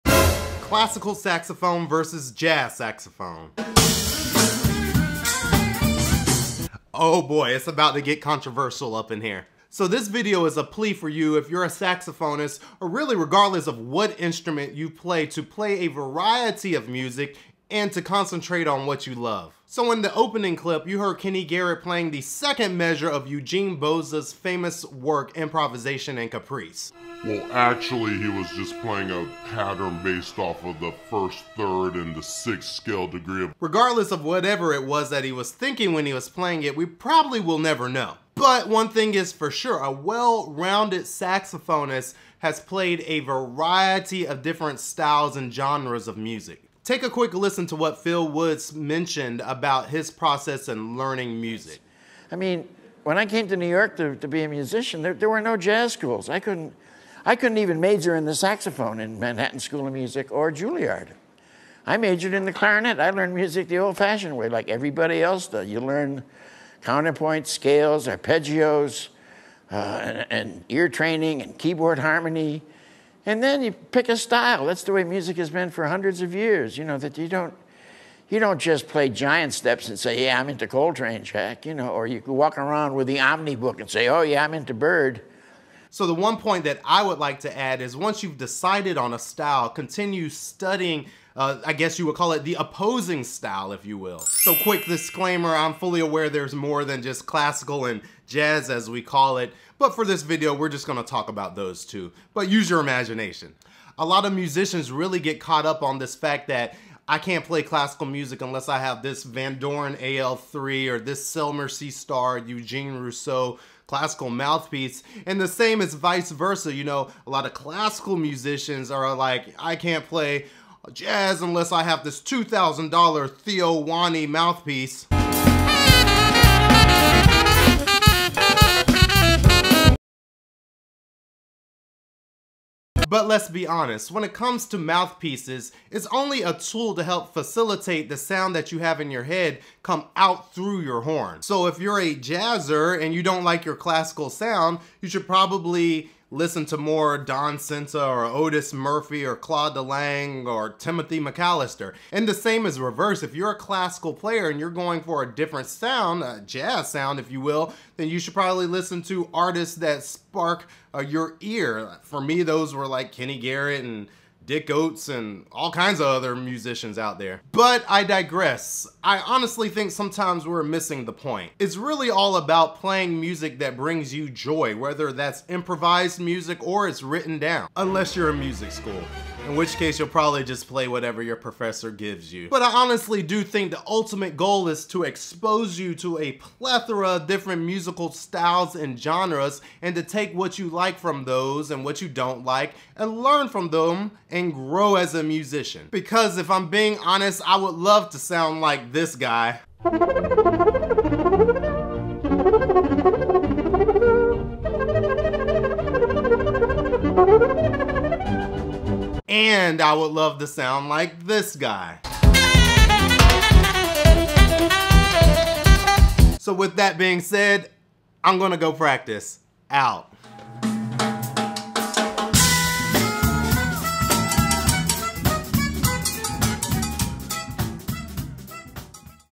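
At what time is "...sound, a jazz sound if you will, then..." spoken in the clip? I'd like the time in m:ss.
2:35.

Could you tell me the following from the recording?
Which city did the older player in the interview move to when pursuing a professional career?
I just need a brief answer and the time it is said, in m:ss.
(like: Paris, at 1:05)
New York, at 0:53.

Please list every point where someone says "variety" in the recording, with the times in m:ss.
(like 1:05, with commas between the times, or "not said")
0:15, 0:43.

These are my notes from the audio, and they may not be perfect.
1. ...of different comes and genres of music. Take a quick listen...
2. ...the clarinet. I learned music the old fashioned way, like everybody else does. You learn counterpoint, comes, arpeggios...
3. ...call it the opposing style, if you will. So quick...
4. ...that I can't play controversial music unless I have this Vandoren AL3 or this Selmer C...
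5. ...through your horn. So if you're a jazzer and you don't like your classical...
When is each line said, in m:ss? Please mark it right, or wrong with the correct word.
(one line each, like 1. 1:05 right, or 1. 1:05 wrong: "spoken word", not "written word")
1. 0:44 wrong: "styles", not "comes"
2. 1:02 wrong: "scales", not "comes"
3. 1:32 right
4. 1:46 wrong: "classical", not "controversial"
5. 2:20 right.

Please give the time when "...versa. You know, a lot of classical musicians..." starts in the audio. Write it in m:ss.
1:56.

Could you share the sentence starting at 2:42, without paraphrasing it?
For me, those were like Kenny Garrett and Dick Oatts and all kinds of other musicians out there.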